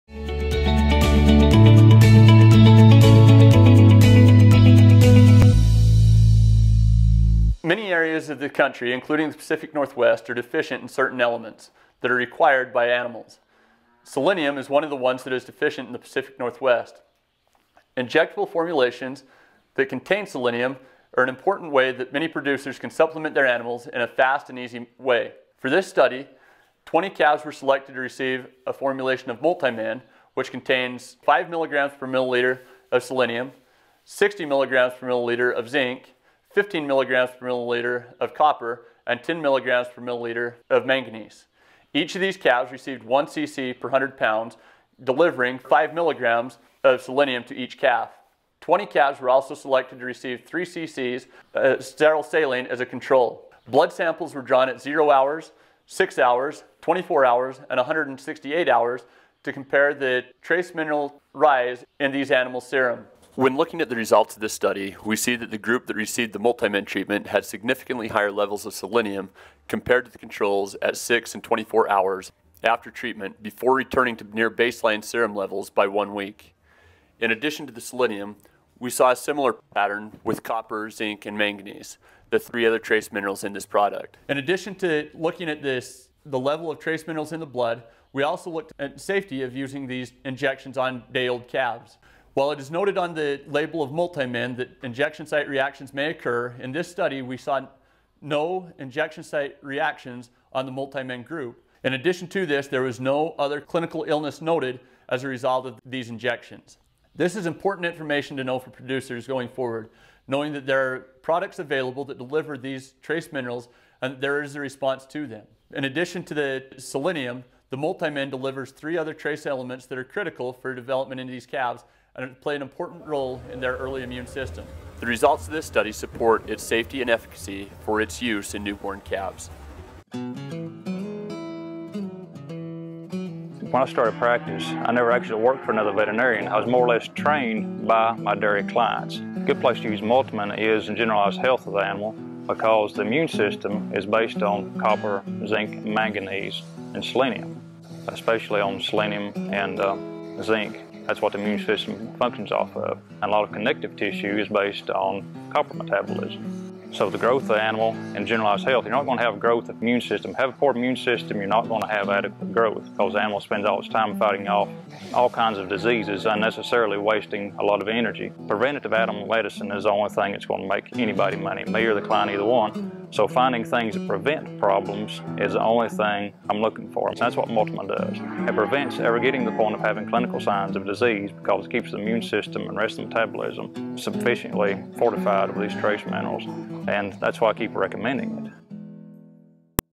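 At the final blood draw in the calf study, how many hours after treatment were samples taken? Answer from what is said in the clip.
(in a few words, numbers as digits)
168 hours.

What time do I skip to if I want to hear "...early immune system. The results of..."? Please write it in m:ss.
2:03.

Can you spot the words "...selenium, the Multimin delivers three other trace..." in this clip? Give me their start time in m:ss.
1:56.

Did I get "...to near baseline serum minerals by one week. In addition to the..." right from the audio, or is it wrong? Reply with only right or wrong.
wrong.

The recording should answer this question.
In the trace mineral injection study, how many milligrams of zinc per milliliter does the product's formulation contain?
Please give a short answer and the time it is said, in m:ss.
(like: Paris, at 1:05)
60 milligrams per milliliter, at 0:34.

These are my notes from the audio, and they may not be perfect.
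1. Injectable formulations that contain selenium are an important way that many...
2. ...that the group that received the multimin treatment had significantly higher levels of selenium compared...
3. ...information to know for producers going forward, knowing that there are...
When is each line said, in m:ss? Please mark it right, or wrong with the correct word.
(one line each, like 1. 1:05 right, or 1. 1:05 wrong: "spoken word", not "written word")
1. 0:17 right
2. 1:05 right
3. 1:47 right.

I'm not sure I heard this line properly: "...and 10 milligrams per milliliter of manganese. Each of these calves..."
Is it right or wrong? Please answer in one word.
right.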